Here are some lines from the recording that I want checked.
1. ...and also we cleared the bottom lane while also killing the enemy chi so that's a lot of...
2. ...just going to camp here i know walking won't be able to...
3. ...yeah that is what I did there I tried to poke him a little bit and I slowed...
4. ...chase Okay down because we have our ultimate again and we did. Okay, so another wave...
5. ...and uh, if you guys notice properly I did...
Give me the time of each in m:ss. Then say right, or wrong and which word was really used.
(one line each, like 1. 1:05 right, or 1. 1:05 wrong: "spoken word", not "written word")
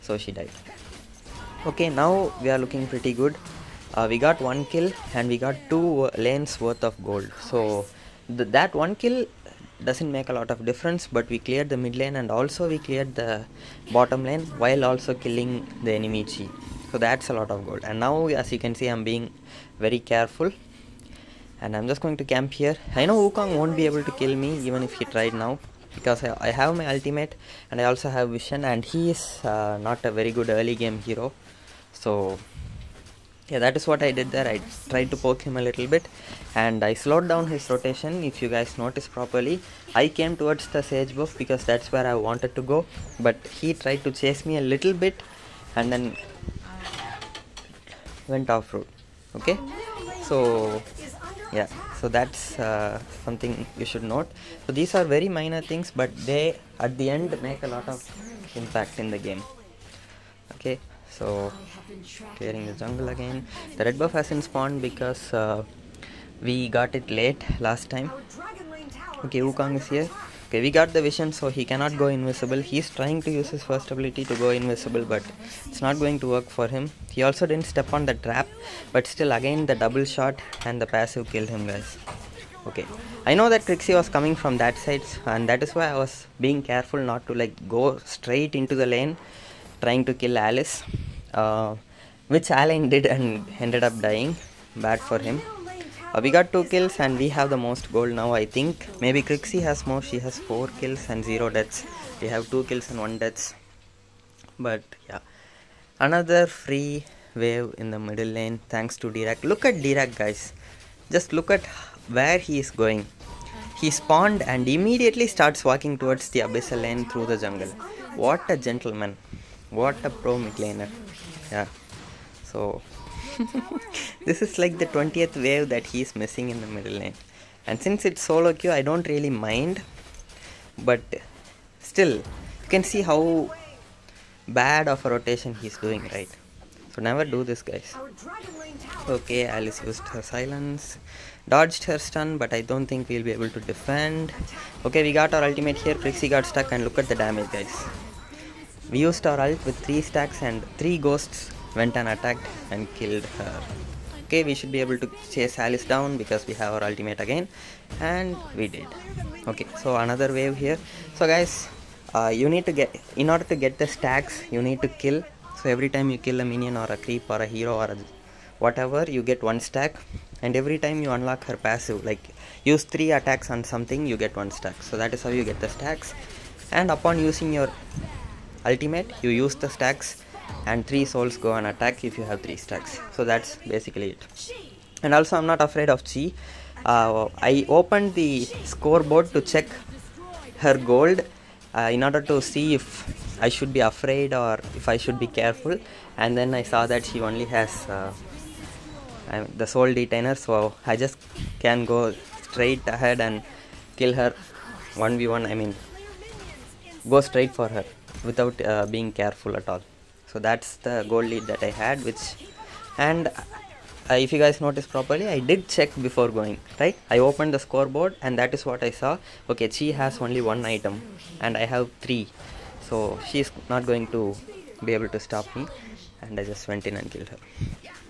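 1. 0:12 right
2. 0:21 wrong: "wukong", not "walking"
3. 0:33 right
4. 2:35 wrong: "Alice", not "Okay"
5. 3:32 right.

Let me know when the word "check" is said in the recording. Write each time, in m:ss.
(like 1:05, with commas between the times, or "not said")
3:09, 3:35.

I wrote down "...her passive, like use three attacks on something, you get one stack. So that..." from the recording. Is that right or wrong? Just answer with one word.
right.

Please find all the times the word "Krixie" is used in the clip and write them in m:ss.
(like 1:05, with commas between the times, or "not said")
1:23, 1:39, 2:25.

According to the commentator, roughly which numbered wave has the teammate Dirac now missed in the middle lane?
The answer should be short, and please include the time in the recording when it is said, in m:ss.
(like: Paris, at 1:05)
20th, at 2:04.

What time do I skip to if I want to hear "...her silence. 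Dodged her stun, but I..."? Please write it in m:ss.
2:20.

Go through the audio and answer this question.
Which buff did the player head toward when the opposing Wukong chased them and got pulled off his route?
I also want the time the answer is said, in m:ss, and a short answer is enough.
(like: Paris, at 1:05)
Sage buff, at 0:40.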